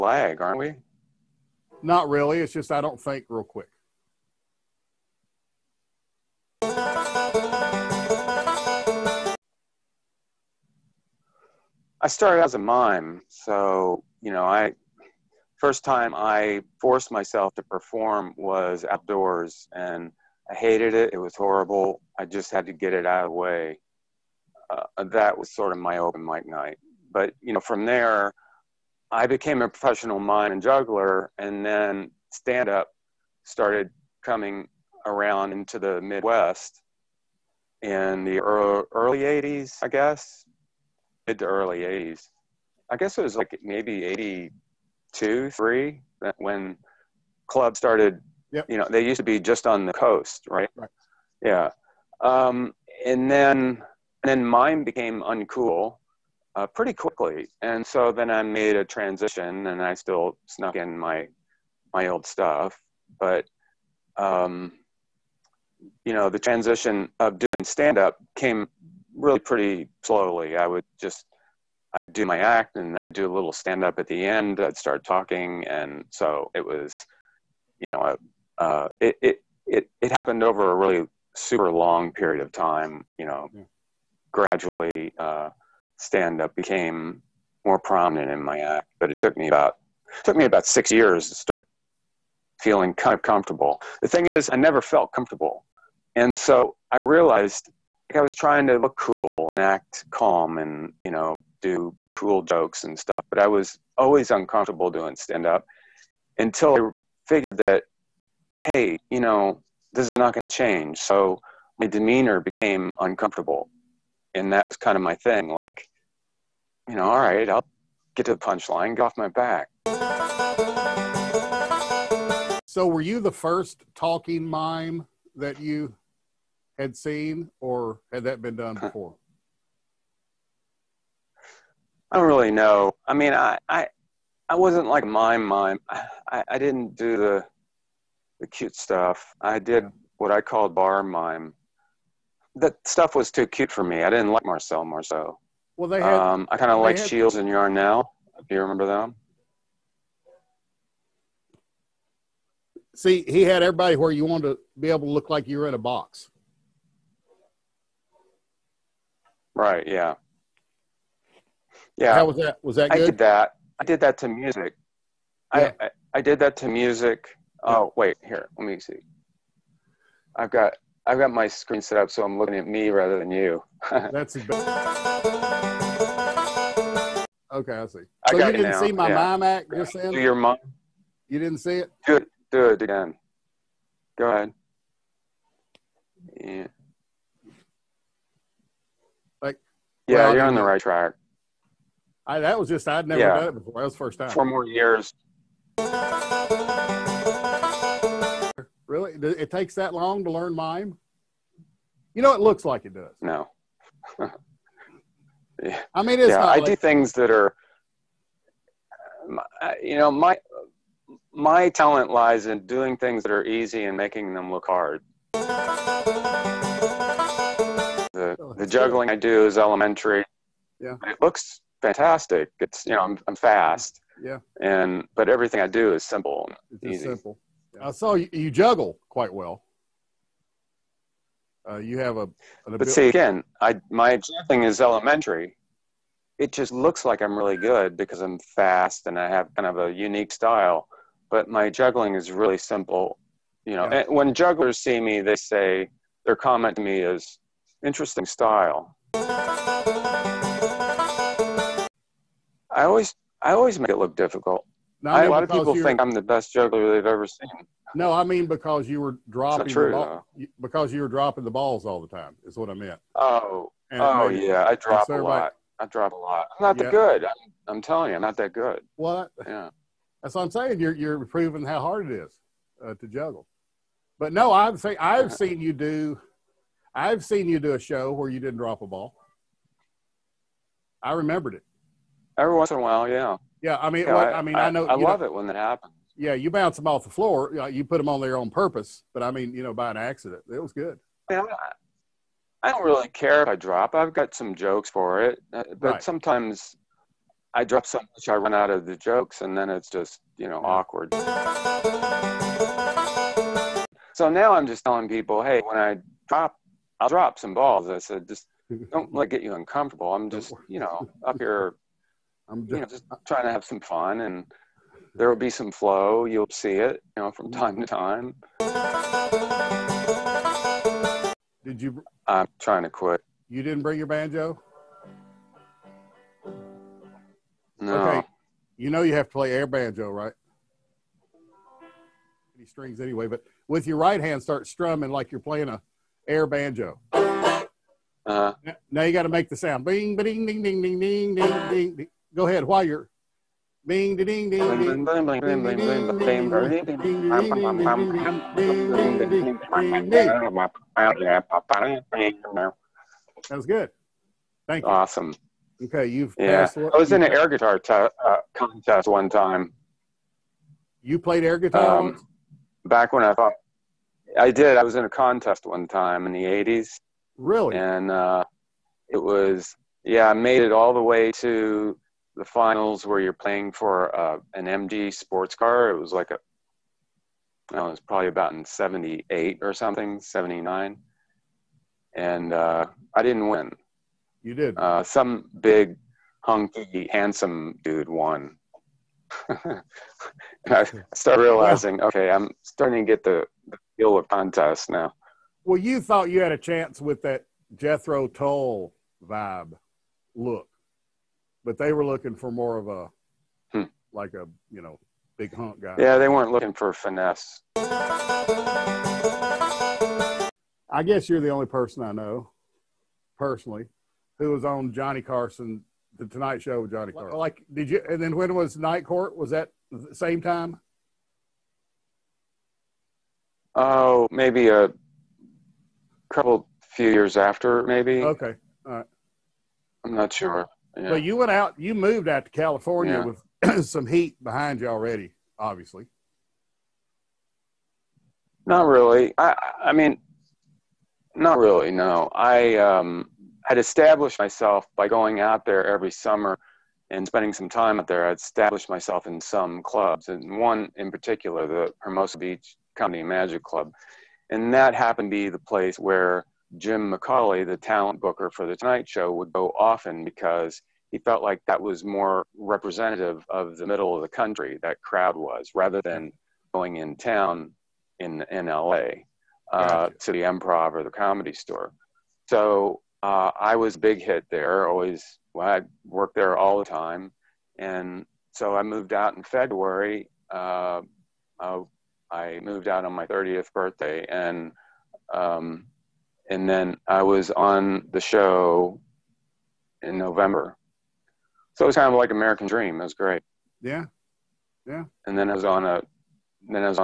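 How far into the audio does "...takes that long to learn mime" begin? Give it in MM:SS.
03:19.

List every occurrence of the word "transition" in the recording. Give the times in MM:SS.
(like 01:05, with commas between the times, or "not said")
00:58, 01:06.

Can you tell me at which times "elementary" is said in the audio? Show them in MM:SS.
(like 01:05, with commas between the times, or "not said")
03:39, 03:54.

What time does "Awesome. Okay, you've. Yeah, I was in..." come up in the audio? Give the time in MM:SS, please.
05:54.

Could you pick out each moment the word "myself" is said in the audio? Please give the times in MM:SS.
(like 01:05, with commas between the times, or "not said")
00:17, 07:24, 07:28.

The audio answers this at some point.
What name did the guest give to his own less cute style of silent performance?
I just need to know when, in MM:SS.
02:20.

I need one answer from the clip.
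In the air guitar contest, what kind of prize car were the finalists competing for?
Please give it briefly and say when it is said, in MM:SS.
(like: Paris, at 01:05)
MG sports car, at 06:14.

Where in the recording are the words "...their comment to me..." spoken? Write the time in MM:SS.
04:06.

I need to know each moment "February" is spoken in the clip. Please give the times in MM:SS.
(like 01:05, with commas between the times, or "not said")
07:59.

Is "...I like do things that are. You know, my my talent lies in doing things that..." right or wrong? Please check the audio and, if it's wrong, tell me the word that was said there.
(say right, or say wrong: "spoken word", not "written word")
right.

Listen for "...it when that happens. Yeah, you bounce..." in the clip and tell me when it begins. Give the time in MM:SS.
04:45.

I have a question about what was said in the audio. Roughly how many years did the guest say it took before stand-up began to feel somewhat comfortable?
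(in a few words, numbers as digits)
6.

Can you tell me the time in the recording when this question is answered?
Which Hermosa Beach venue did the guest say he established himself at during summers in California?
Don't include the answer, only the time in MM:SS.
07:33.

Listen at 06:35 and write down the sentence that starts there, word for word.
Well, you thought you had a chance with that Jethro Tull vibe look, but they were looking for more of a hmm.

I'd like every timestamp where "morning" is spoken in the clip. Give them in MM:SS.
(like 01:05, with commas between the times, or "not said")
not said.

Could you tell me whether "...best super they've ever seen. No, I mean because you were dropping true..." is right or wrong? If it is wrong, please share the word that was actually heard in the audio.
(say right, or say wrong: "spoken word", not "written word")
wrong: "juggler", not "super".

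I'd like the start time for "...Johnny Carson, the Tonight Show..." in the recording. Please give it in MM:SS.
06:54.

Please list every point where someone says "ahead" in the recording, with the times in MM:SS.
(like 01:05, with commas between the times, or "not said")
03:04, 05:42.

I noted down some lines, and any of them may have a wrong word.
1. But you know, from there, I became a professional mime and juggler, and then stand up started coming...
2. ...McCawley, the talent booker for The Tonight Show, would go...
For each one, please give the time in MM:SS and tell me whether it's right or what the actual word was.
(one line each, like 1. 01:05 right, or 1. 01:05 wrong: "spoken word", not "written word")
1. 00:27 right
2. 07:37 right.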